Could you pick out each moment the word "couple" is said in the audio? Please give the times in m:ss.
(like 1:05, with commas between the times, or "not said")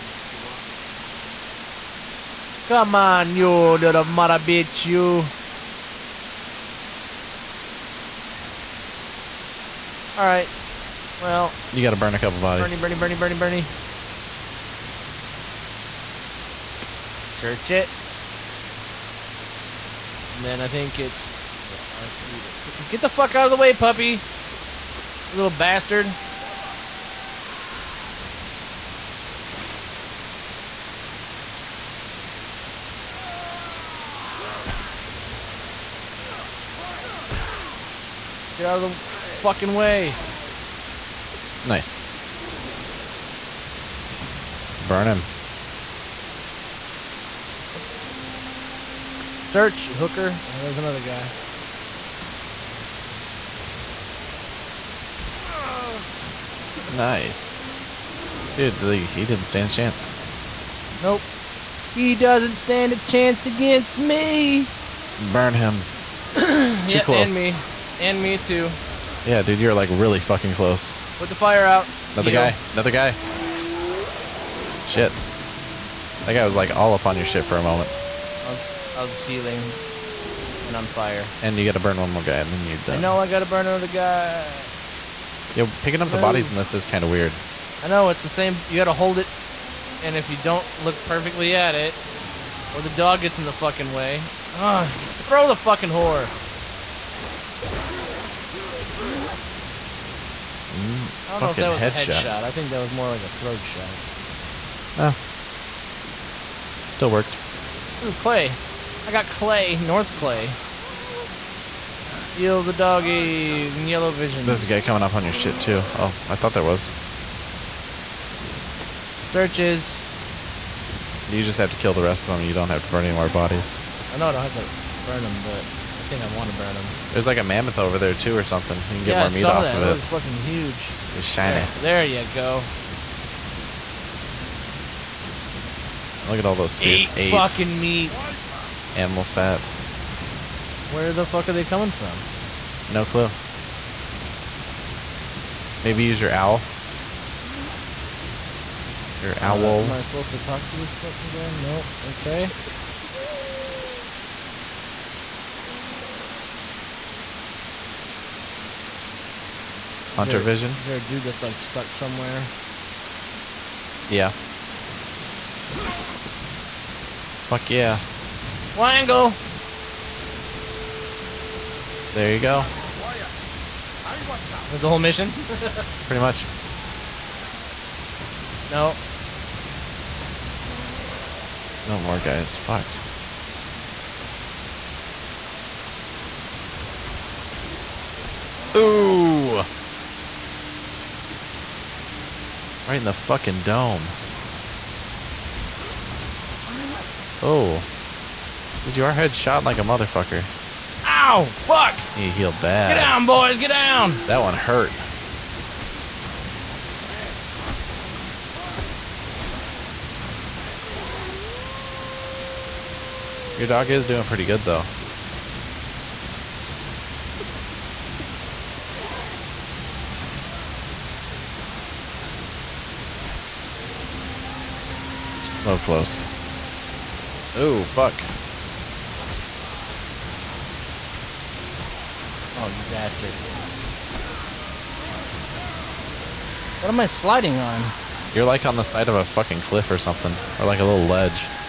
0:12.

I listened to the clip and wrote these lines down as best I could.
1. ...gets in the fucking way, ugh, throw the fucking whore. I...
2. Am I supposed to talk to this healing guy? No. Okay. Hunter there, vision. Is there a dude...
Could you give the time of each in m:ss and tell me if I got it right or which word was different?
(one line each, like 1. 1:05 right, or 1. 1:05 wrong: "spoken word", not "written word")
1. 1:33 right
2. 2:29 wrong: "fucking", not "healing".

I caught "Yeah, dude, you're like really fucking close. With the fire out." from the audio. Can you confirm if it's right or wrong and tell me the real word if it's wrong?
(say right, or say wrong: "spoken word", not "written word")
right.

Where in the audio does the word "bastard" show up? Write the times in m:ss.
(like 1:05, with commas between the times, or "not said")
0:25, 3:52.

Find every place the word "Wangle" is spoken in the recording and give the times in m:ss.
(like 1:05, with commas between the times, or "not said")
2:48.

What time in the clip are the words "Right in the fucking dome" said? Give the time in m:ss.
3:12.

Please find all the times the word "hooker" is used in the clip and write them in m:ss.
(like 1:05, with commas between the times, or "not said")
0:49.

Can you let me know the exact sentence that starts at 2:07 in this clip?
There's like a mammoth over there too, or something.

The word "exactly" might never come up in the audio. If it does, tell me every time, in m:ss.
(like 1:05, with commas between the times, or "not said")
not said.